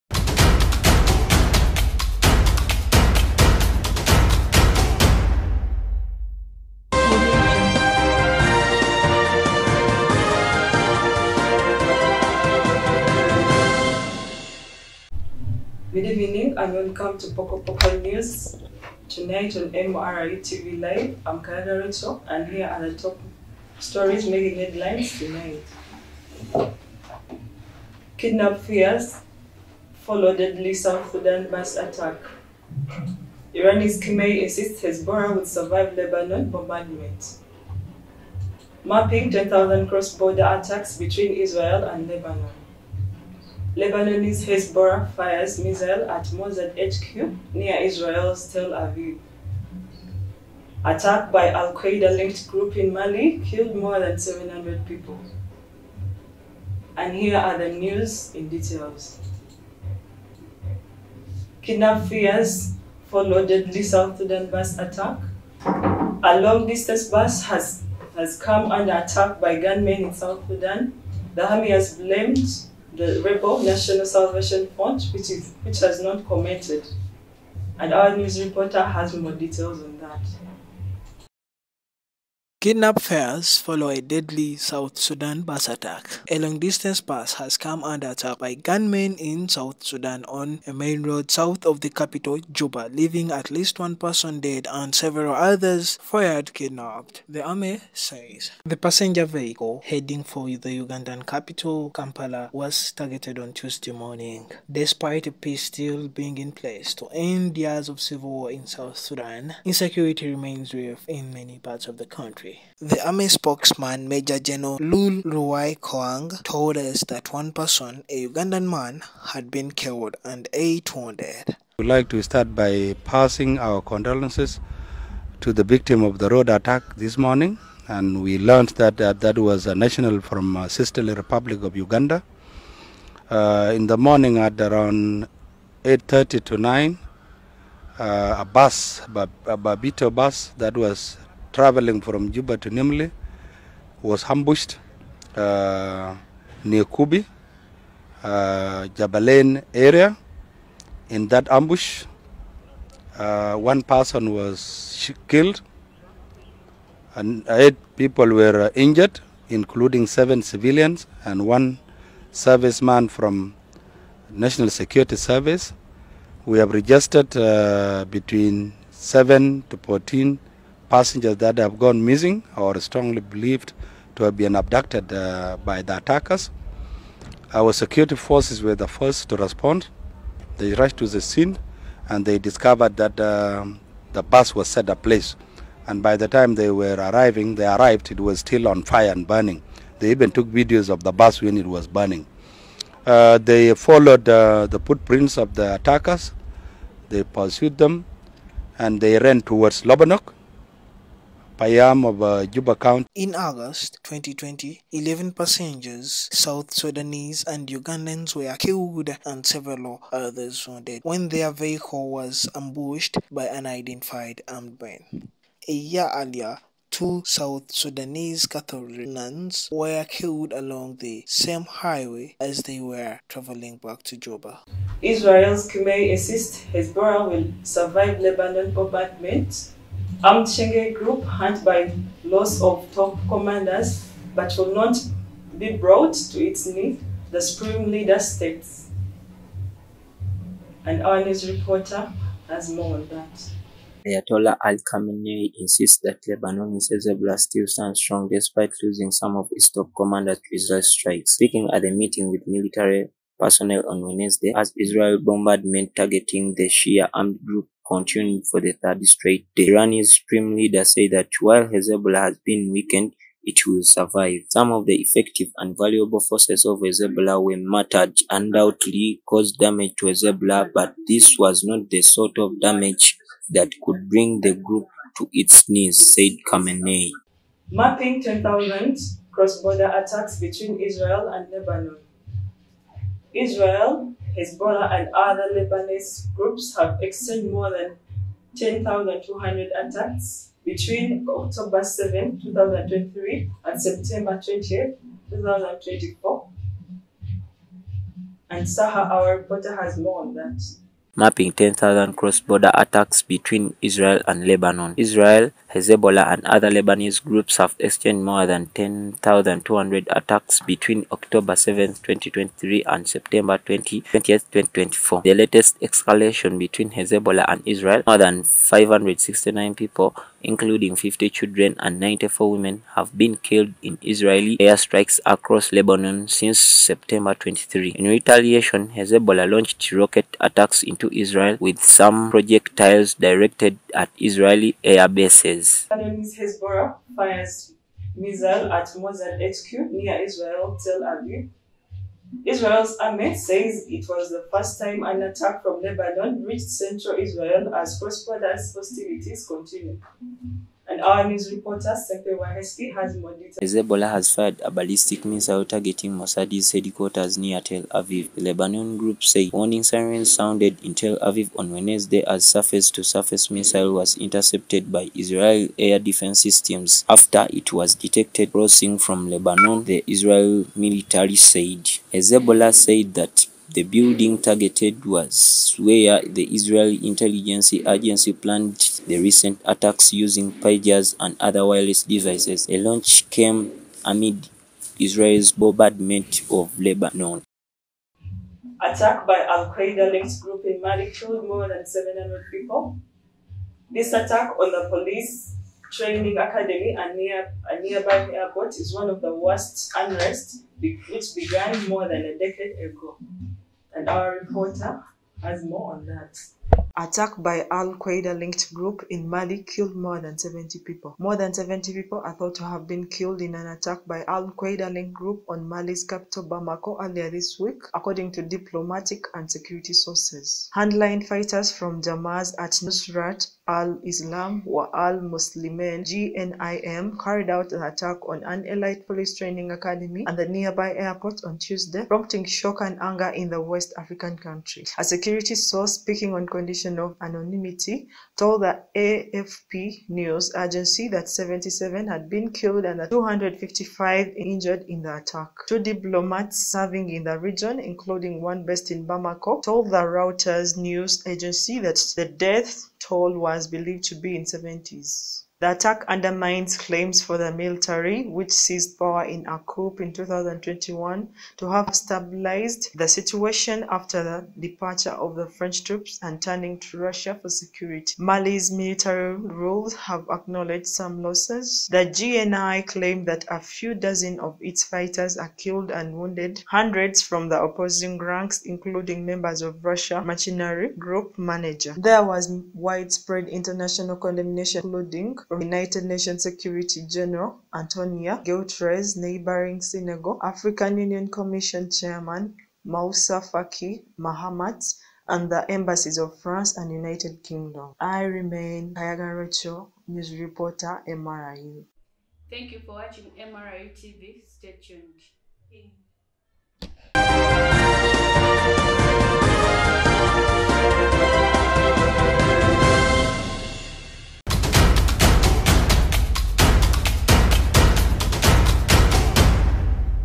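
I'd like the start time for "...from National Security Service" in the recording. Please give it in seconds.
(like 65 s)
163 s.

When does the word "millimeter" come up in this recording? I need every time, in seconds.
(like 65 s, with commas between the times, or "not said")
not said.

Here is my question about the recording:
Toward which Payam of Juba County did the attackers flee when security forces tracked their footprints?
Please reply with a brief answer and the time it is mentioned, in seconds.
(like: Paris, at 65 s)
Lobonok, at 199 s.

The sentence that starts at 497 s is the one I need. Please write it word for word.
I remain Kayagan Rocho, news reporter, MRU.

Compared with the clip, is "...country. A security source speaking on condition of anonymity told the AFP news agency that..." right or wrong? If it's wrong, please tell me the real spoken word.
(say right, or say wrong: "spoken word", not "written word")
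right.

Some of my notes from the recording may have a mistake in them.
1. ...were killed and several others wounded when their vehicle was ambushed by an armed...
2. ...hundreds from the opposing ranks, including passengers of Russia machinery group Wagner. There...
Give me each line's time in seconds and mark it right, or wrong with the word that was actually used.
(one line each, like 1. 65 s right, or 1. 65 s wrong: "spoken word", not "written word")
1. 208 s right
2. 476 s wrong: "members", not "passengers".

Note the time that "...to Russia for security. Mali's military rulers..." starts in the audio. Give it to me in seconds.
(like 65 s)
466 s.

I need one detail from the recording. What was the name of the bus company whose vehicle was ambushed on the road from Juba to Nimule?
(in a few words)
Babito.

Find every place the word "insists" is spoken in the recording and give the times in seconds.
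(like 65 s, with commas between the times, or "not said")
34 s, 226 s, 245 s.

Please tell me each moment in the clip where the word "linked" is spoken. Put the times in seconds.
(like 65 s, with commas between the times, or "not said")
52 s, 389 s, 408 s, 414 s.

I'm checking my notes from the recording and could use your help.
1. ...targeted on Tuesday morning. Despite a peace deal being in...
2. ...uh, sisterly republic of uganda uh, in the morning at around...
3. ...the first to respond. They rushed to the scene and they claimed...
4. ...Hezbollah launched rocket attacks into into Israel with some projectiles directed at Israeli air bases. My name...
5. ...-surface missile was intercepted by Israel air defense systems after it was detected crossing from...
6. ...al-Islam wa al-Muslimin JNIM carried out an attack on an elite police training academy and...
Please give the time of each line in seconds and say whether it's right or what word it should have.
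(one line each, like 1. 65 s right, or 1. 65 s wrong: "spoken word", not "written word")
1. 102 s right
2. 130 s right
3. 178 s wrong: "discovered", not "claimed"
4. 328 s right
5. 363 s right
6. 423 s right.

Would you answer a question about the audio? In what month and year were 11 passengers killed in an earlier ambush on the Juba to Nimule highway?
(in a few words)
August 2020.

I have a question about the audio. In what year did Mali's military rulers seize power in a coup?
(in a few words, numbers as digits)
2021.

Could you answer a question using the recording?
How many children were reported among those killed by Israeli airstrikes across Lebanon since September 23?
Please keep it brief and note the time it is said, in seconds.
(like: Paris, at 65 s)
50, at 320 s.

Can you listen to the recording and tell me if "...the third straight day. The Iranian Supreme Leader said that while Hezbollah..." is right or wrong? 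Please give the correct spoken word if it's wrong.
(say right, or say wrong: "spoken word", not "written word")
right.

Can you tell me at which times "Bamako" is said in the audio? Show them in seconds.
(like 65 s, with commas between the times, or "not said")
416 s, 449 s.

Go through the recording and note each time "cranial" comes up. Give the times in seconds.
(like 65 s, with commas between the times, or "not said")
not said.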